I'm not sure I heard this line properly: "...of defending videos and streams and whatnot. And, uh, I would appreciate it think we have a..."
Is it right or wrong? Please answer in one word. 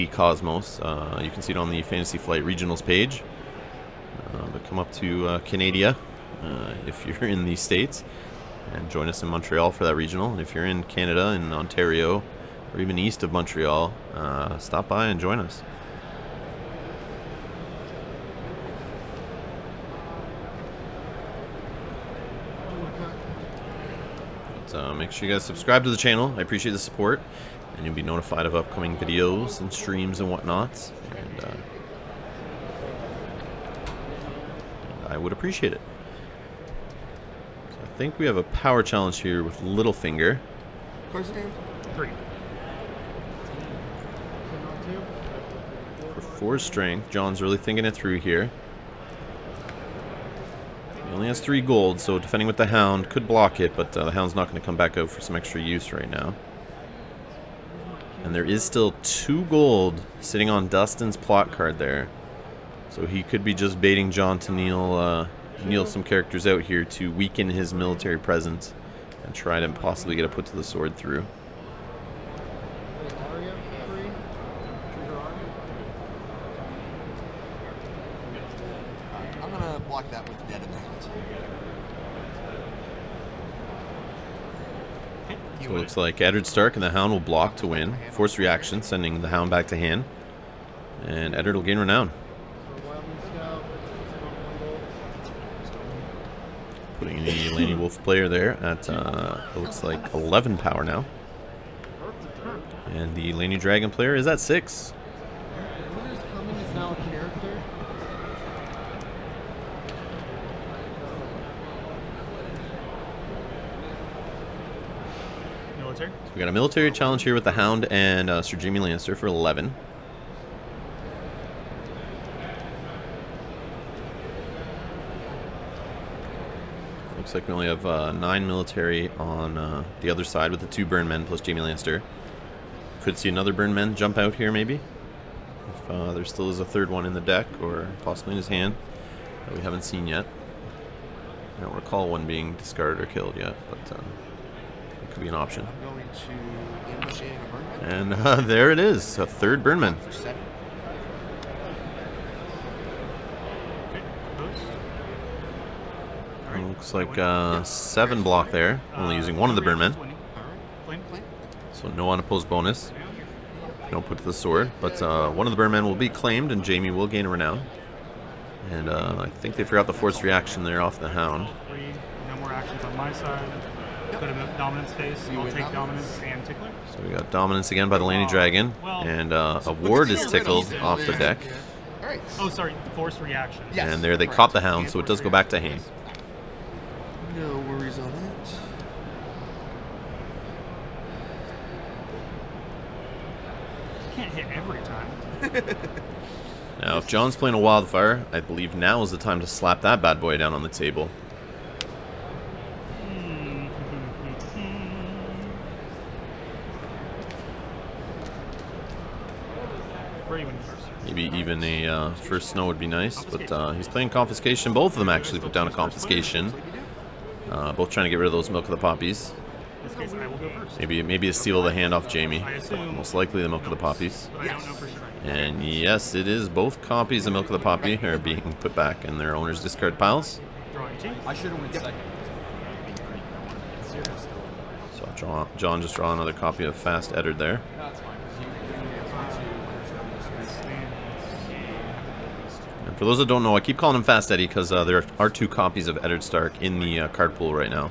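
wrong.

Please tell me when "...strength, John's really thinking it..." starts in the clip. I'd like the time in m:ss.
0:46.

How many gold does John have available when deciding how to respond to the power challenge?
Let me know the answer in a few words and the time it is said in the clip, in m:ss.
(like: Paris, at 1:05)
3, at 0:51.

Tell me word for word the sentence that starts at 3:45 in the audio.
And yes, it is both copies of Milk of the Poppy are being put back in their owner's discard piles.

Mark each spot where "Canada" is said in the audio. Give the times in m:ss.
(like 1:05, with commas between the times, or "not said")
0:05, 0:10.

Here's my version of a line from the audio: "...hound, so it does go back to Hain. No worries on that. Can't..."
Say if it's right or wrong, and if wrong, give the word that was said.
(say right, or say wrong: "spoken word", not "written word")
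right.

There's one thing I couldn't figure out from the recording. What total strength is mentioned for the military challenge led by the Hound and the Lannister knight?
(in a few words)
11.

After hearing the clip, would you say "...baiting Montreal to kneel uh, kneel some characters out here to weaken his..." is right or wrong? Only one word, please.
wrong.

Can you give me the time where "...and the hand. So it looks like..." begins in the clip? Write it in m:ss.
1:20.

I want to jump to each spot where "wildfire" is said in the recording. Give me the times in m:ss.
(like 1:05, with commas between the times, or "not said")
3:17.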